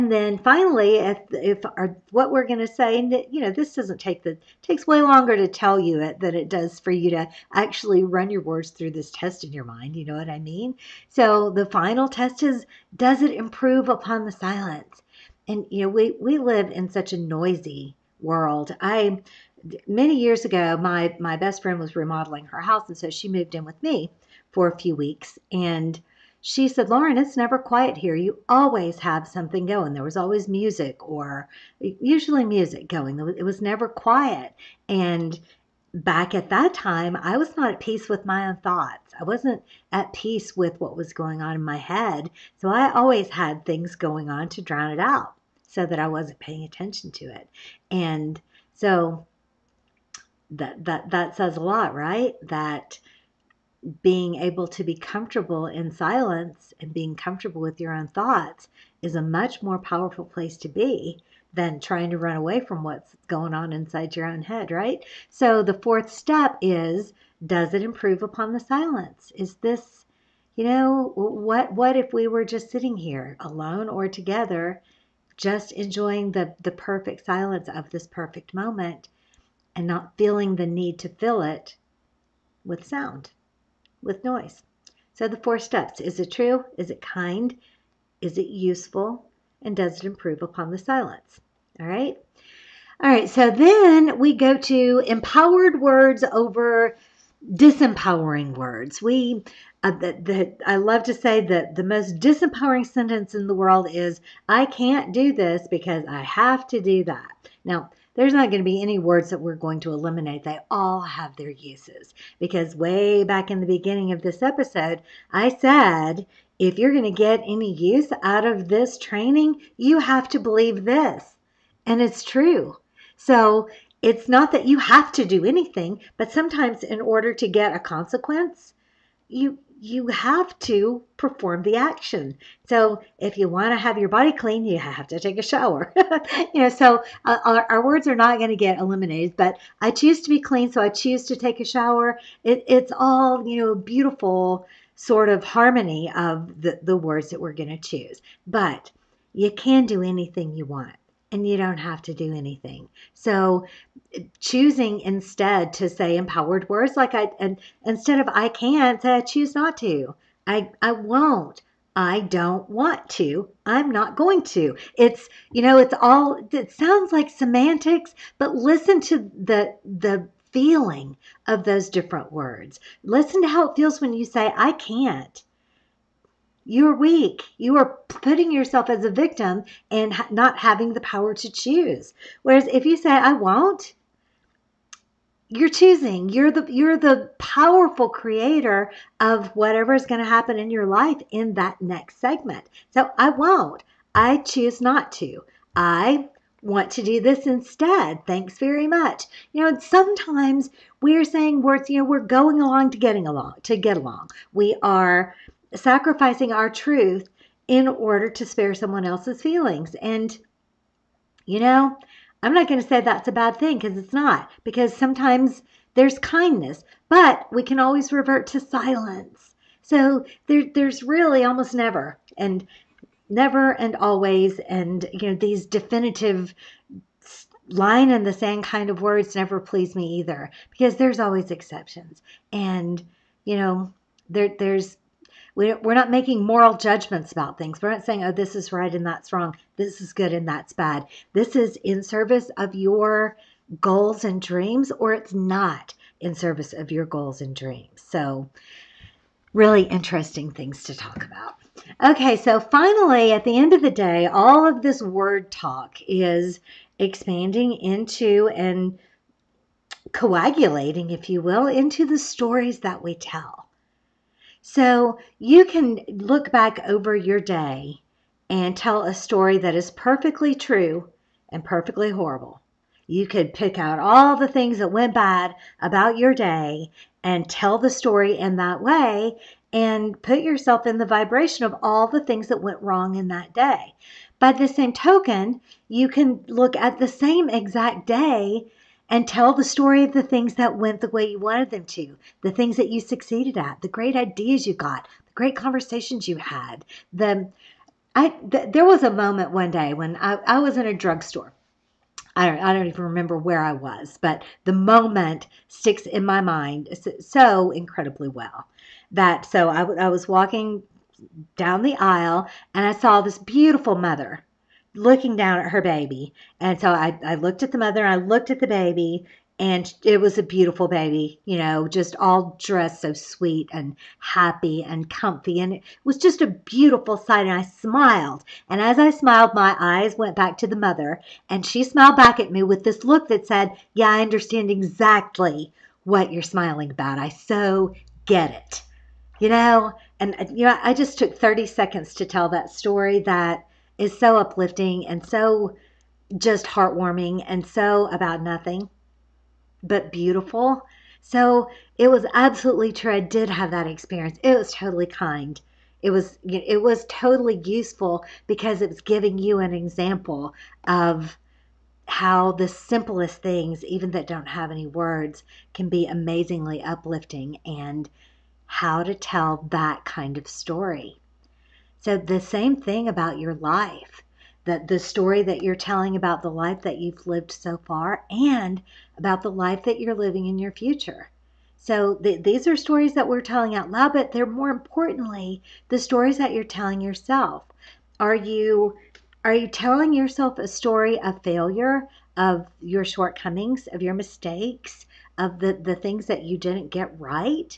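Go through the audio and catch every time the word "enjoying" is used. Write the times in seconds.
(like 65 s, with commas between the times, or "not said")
75 s.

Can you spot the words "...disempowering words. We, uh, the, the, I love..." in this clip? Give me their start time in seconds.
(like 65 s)
97 s.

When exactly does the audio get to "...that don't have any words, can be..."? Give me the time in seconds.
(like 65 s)
364 s.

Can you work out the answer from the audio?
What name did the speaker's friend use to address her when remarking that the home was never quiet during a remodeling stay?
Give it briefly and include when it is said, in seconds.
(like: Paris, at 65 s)
Lauren, at 26 s.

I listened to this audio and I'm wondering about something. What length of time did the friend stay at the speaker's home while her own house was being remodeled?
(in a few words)
a few weeks.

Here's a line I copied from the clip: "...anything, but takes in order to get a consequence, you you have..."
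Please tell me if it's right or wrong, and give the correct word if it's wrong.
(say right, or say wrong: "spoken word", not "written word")
wrong: "sometimes", not "takes".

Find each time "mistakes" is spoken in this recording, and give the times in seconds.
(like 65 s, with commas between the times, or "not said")
394 s.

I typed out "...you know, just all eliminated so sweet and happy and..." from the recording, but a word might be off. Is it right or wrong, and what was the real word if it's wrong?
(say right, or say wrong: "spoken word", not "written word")
wrong: "dressed", not "eliminated".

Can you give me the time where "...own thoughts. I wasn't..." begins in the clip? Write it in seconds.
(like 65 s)
38 s.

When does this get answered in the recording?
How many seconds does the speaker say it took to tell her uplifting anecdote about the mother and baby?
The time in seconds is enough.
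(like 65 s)
341 s.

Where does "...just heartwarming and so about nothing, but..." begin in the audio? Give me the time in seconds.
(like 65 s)
346 s.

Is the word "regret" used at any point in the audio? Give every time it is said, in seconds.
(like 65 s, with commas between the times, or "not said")
not said.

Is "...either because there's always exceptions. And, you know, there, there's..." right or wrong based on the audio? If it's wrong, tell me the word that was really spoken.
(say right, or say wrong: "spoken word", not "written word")
right.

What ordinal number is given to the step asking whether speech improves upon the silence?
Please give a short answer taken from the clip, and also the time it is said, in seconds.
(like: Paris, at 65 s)
fourth, at 65 s.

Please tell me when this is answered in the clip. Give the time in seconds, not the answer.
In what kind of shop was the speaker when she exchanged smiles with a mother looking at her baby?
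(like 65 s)
300 s.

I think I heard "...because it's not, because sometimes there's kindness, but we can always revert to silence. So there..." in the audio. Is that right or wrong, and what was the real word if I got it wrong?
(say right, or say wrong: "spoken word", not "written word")
right.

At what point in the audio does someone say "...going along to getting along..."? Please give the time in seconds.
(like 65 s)
202 s.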